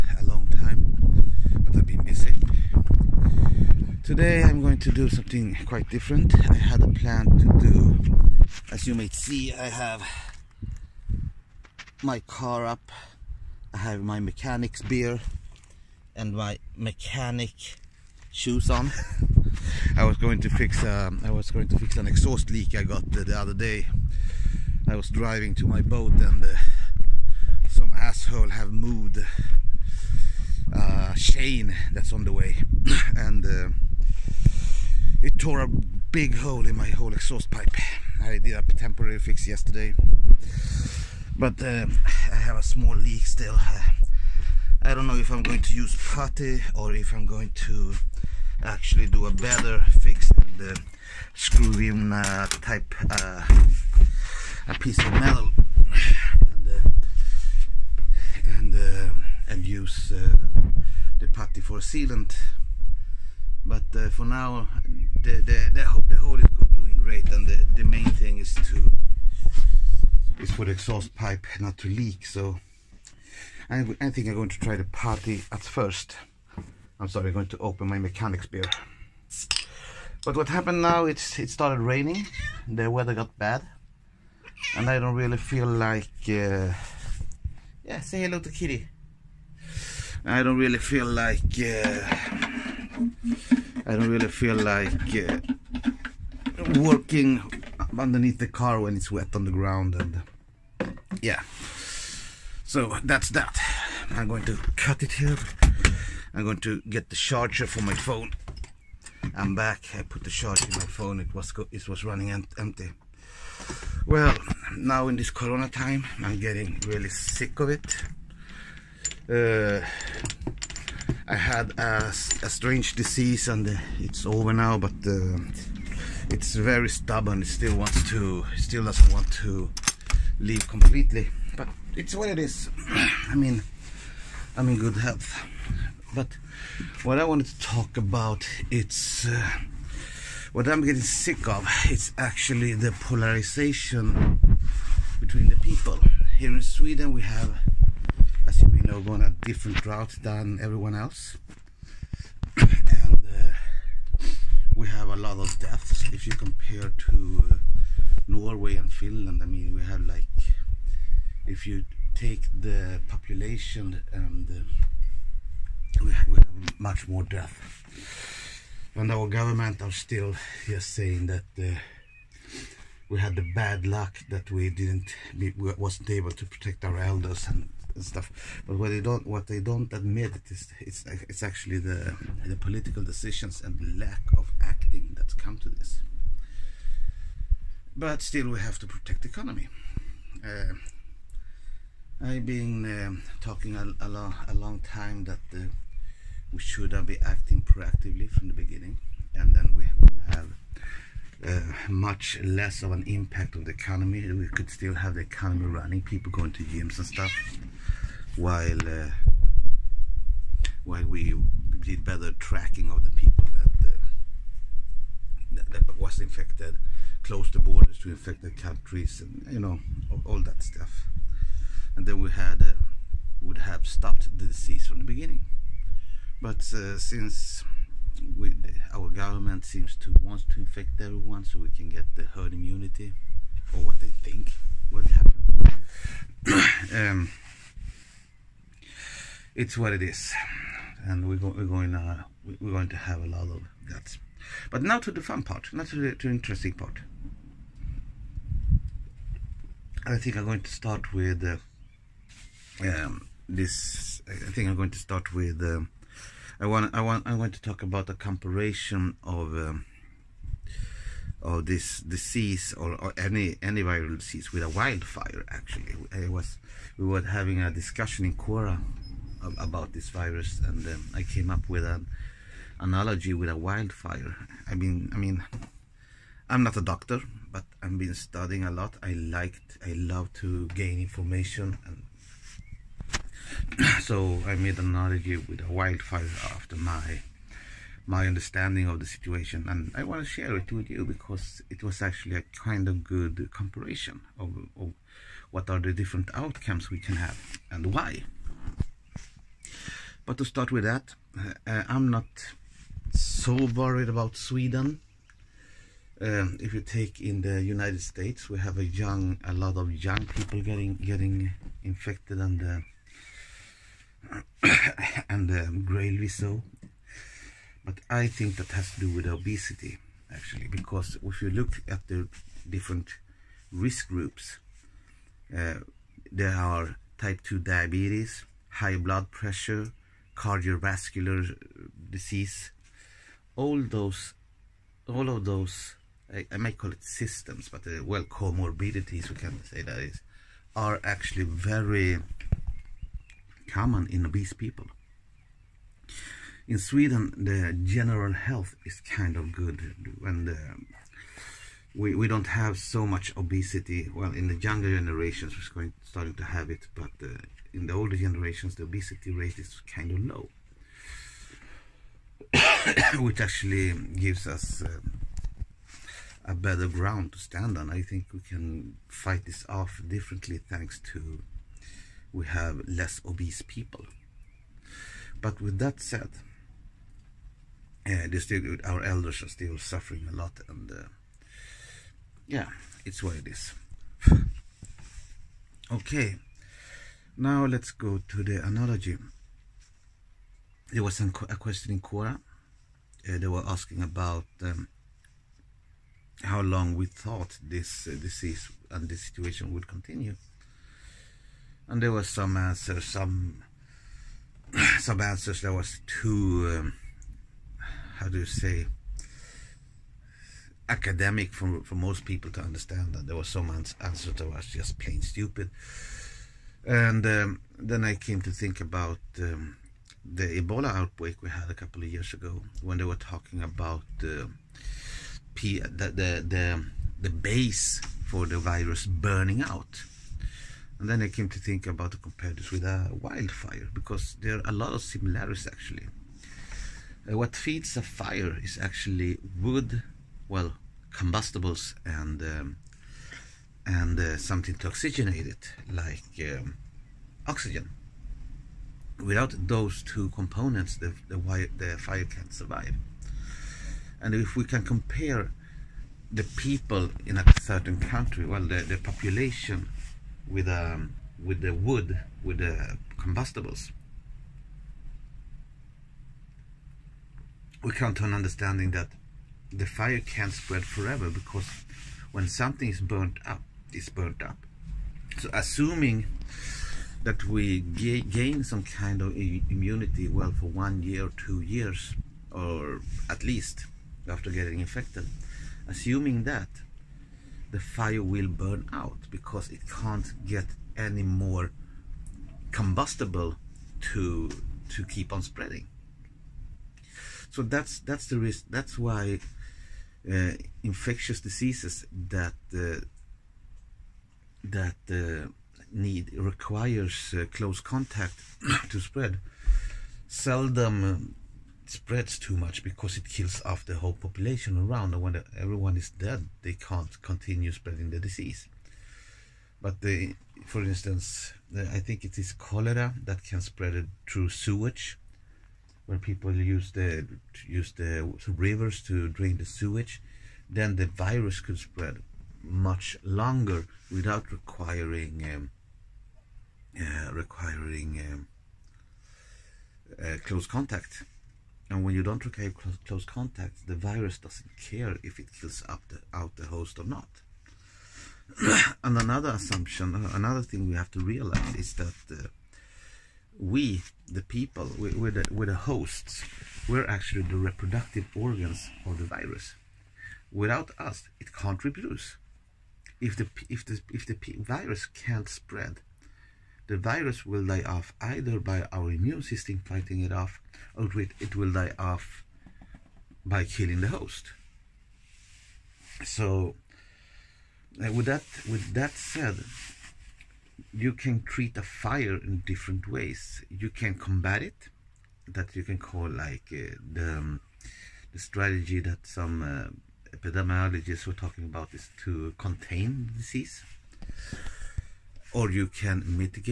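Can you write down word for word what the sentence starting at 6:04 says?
Uh, a better ground to stand on.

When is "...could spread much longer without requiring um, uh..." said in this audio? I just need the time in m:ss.
8:51.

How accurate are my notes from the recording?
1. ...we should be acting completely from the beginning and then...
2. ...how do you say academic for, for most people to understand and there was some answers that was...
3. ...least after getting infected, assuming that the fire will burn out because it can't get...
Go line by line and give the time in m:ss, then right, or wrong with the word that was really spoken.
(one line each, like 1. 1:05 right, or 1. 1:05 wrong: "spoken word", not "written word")
1. 3:16 wrong: "proactively", not "completely"
2. 6:48 right
3. 8:03 right.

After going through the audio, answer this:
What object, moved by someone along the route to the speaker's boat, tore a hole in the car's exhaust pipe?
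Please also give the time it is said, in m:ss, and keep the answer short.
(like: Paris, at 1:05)
chain, at 0:31.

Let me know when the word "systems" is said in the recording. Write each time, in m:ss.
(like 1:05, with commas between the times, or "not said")
5:37, 9:29.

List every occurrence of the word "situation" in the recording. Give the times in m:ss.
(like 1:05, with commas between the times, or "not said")
4:49, 6:39.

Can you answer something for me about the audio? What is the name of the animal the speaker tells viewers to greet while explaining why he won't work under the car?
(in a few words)
Kitty.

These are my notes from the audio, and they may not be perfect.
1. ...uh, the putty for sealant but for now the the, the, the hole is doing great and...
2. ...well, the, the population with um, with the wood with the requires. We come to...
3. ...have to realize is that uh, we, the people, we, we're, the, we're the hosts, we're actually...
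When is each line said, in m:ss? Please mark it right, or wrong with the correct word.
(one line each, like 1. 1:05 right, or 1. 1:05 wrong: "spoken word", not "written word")
1. 1:00 right
2. 7:38 wrong: "combustibles", not "requires"
3. 9:10 right.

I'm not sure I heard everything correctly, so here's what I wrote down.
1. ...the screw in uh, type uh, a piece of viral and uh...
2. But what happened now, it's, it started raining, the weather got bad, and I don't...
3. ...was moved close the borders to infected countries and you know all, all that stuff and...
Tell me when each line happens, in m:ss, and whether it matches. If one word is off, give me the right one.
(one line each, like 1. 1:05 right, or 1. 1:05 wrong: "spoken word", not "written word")
1. 0:50 wrong: "metal", not "viral"
2. 1:20 right
3. 3:35 wrong: "infected", not "moved".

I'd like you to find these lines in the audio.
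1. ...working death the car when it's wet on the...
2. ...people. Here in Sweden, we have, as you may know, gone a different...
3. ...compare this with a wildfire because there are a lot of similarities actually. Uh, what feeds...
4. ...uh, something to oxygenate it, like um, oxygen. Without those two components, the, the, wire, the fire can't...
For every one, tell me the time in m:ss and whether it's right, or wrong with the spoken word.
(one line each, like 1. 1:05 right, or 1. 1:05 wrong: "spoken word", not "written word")
1. 1:36 wrong: "underneath", not "death"
2. 2:25 right
3. 7:12 right
4. 7:24 right.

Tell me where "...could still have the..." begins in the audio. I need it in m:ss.
3:24.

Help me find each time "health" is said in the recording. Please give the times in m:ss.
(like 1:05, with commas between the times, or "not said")
2:14, 5:48.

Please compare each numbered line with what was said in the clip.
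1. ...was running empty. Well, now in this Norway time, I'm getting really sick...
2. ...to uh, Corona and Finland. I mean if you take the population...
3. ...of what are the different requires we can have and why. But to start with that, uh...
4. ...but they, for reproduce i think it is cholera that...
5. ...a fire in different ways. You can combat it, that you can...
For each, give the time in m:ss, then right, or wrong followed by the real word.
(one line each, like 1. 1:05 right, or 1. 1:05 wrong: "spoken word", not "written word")
1. 1:51 wrong: "Corona", not "Norway"
2. 2:36 wrong: "Norway", not "Corona"
3. 4:54 wrong: "outcomes", not "requires"
4. 8:39 wrong: "instance", not "reproduce"
5. 9:41 right.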